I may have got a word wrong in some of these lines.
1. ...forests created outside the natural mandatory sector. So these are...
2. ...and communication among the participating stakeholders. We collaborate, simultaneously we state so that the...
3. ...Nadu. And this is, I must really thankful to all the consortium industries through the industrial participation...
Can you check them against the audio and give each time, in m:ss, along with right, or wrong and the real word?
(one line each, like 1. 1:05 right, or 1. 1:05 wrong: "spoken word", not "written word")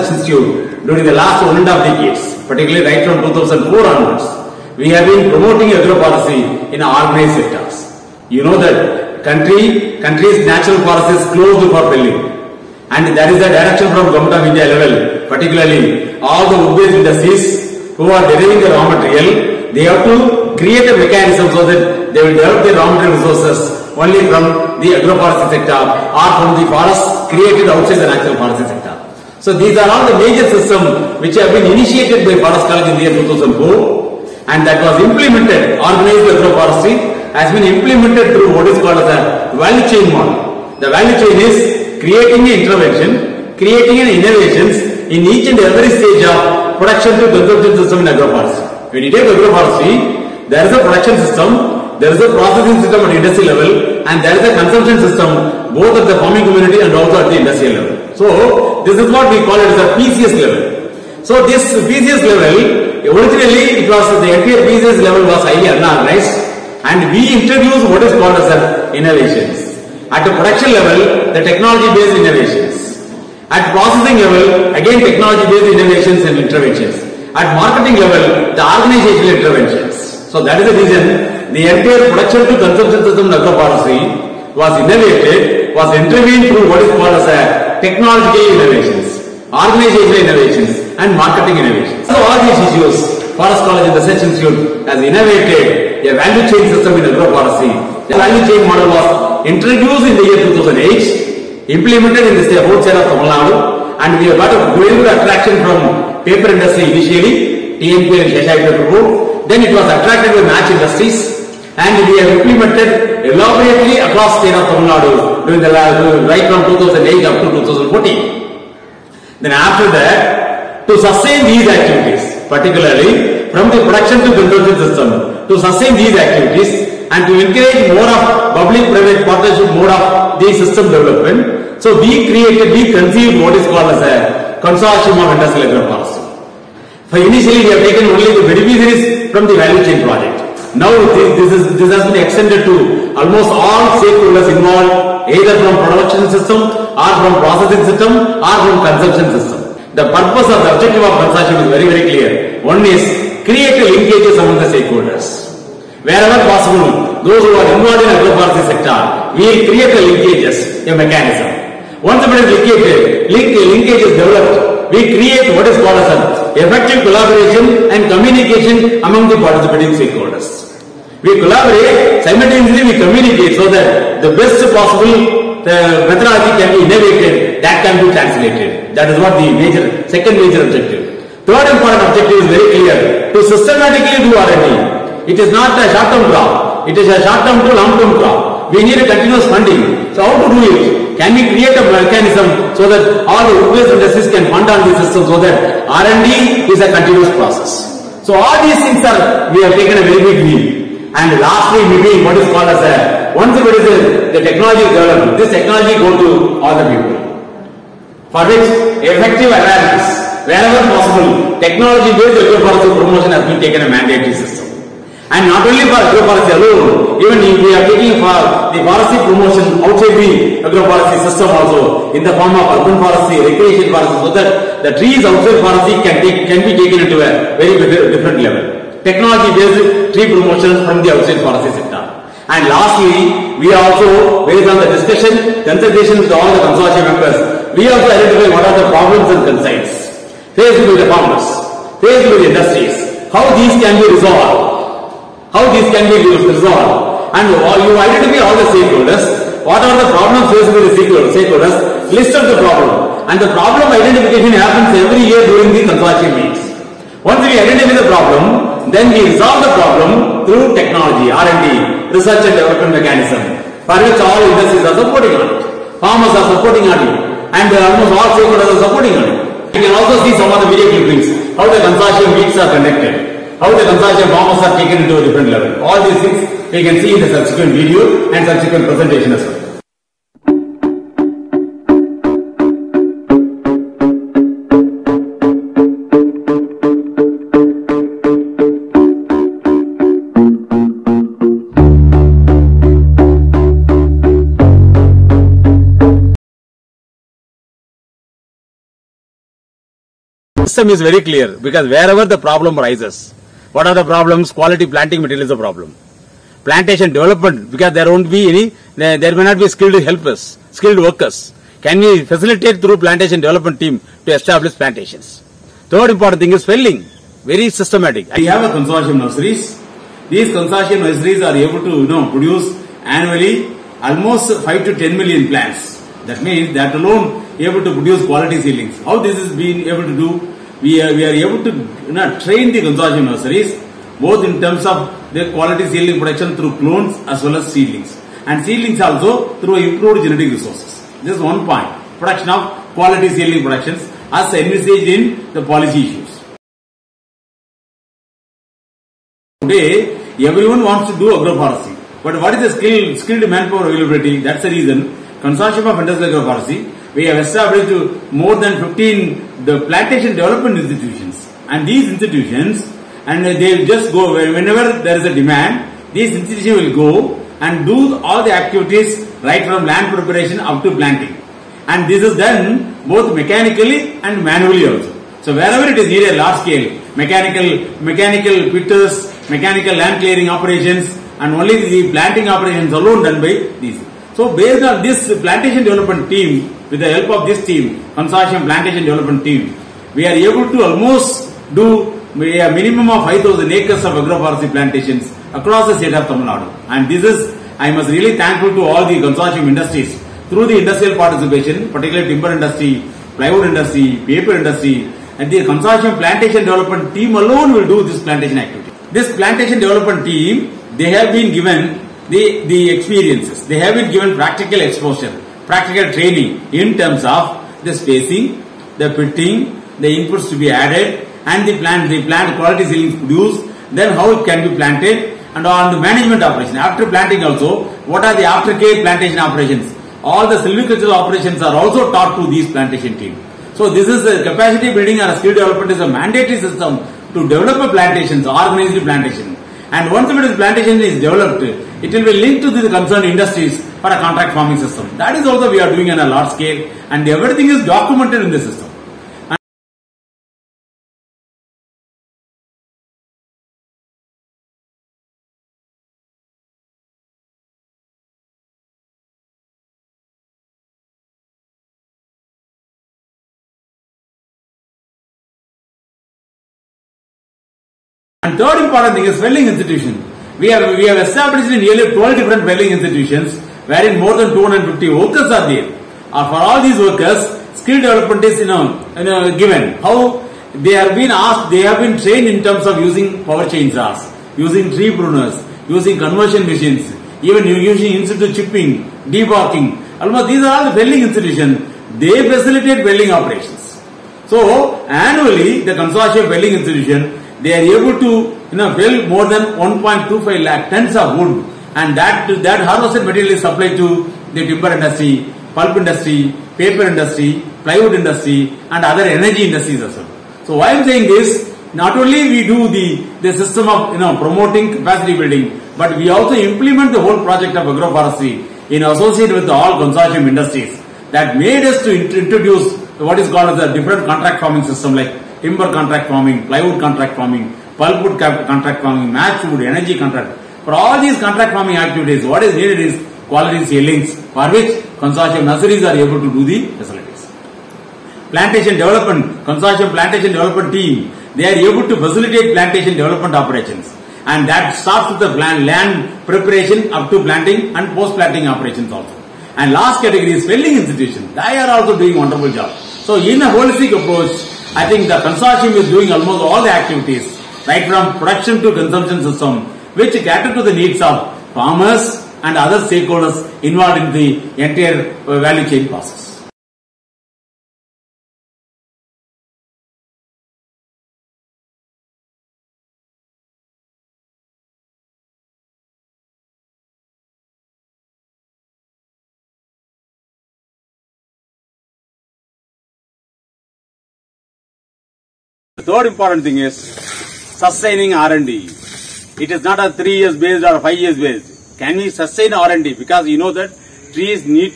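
1. 0:26 wrong: "forestry", not "mandatory"
2. 2:47 wrong: "communicate", not "state"
3. 6:36 right.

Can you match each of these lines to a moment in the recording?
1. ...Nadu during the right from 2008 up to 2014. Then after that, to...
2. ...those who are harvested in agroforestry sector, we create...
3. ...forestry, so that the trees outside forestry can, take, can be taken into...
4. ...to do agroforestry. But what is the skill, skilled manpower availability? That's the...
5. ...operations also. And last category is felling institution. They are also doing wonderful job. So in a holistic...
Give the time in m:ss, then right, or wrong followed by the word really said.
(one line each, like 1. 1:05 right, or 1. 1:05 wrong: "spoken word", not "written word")
1. 1:54 right
2. 2:37 wrong: "involved", not "harvested"
3. 3:43 right
4. 5:51 right
5. 9:08 right.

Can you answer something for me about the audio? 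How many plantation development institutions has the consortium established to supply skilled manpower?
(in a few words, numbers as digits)
more than 15.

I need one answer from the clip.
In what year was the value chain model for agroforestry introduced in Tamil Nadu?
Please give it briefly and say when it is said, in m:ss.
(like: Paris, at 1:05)
2008, at 1:39.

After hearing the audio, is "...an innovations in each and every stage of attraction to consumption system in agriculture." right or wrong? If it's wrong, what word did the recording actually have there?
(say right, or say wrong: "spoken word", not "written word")
wrong: "production", not "attraction".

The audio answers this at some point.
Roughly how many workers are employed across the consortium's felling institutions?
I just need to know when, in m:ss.
7:54.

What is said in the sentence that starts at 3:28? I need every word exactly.
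For which effective awareness, wherever possible, technology-based promotion has been taken a mandate basis.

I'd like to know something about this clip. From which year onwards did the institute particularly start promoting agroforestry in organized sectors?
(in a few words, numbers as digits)
2004.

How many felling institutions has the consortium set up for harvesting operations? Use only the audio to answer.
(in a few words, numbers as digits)
12.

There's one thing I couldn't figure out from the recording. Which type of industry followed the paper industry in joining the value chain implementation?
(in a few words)
match industries.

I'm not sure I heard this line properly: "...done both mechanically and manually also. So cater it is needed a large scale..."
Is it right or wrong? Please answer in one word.
wrong.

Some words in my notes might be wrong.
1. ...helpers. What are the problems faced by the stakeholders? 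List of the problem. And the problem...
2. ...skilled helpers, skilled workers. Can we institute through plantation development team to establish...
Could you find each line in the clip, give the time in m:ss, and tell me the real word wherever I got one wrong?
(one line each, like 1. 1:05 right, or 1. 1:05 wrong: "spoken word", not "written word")
1. 4:08 wrong: "stakeholders", not "helpers"
2. 5:09 wrong: "facilitate", not "institute".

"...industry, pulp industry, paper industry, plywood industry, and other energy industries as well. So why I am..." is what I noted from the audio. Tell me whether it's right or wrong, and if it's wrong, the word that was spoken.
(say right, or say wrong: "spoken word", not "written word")
right.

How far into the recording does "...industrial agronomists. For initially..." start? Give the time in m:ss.
2:15.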